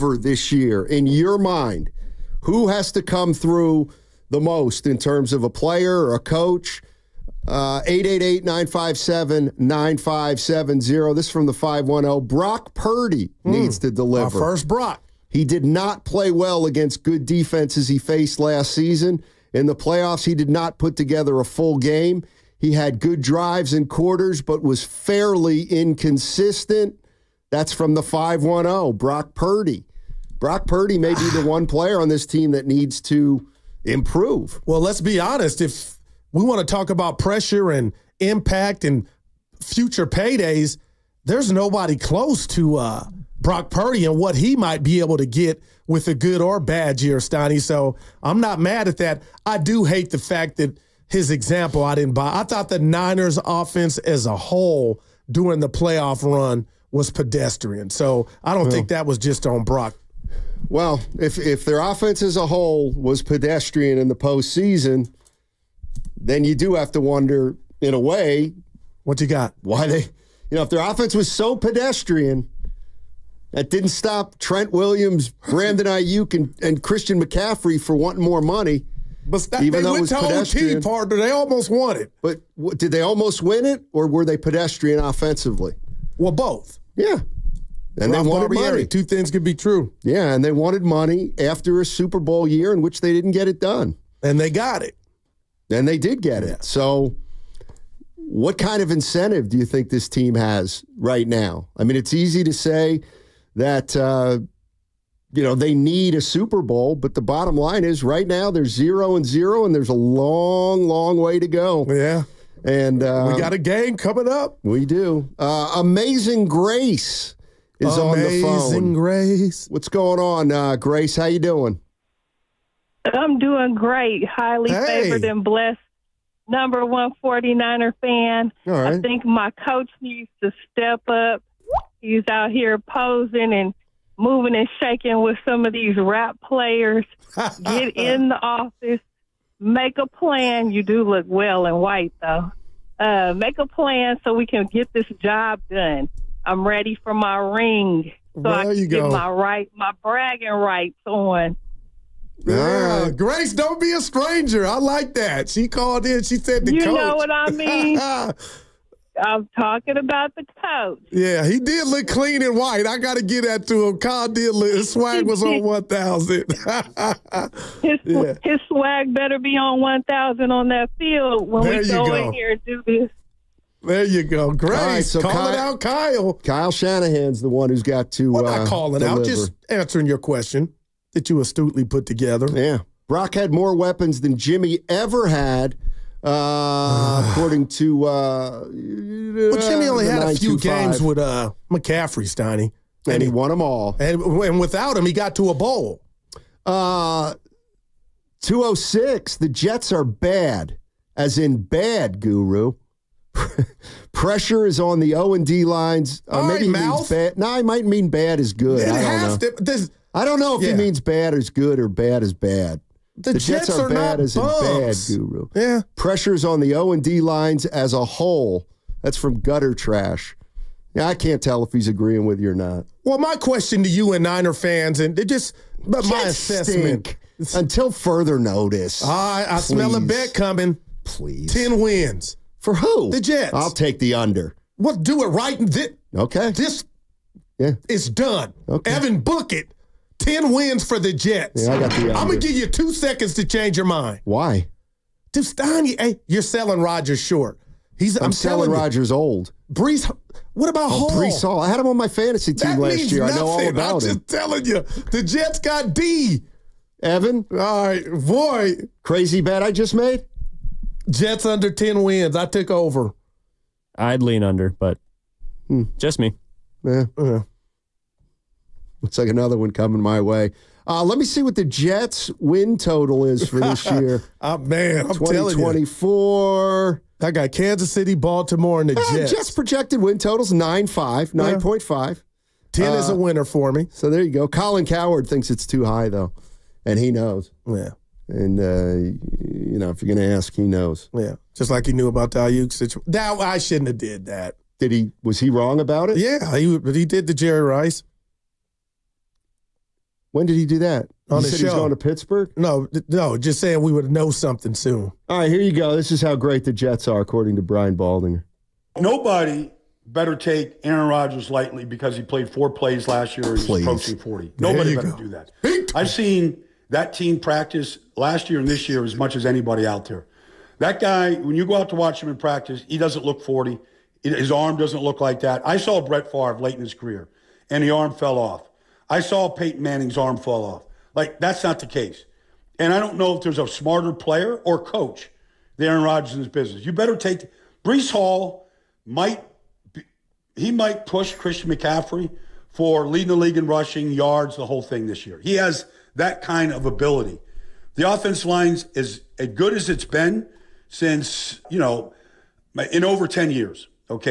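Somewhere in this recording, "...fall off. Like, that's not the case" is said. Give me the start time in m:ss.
5:30.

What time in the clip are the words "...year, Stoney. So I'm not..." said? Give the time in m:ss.
0:47.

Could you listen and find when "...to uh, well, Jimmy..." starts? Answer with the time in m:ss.
3:07.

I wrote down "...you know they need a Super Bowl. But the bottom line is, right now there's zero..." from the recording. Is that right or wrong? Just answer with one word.
right.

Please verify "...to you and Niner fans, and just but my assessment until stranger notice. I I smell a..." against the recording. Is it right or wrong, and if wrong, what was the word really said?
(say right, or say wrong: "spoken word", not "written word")
wrong: "further", not "stranger".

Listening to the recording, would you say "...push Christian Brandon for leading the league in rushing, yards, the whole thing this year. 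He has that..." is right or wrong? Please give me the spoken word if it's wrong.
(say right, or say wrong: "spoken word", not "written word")
wrong: "McCaffrey", not "Brandon".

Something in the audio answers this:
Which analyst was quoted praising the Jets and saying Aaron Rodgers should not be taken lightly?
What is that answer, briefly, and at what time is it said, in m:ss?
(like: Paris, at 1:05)
Brian Baldinger, at 5:07.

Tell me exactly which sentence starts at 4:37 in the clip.
I got Kansas City, Baltimore, and the uh, Jets.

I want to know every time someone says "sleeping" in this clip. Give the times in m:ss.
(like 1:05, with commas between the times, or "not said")
not said.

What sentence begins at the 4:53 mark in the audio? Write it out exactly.
Now, I shouldn't have did that.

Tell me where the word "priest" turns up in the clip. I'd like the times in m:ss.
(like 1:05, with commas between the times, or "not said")
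not said.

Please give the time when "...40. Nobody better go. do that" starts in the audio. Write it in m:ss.
5:14.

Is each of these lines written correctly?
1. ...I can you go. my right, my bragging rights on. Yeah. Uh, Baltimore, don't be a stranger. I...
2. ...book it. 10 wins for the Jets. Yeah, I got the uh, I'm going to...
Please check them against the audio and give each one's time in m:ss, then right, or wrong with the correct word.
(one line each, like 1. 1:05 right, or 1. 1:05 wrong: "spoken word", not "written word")
1. 2:28 wrong: "Grace", not "Baltimore"
2. 3:59 right.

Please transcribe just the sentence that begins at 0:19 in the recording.
In the playoffs, he did not put together a full game.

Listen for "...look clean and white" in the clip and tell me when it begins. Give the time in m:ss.
2:41.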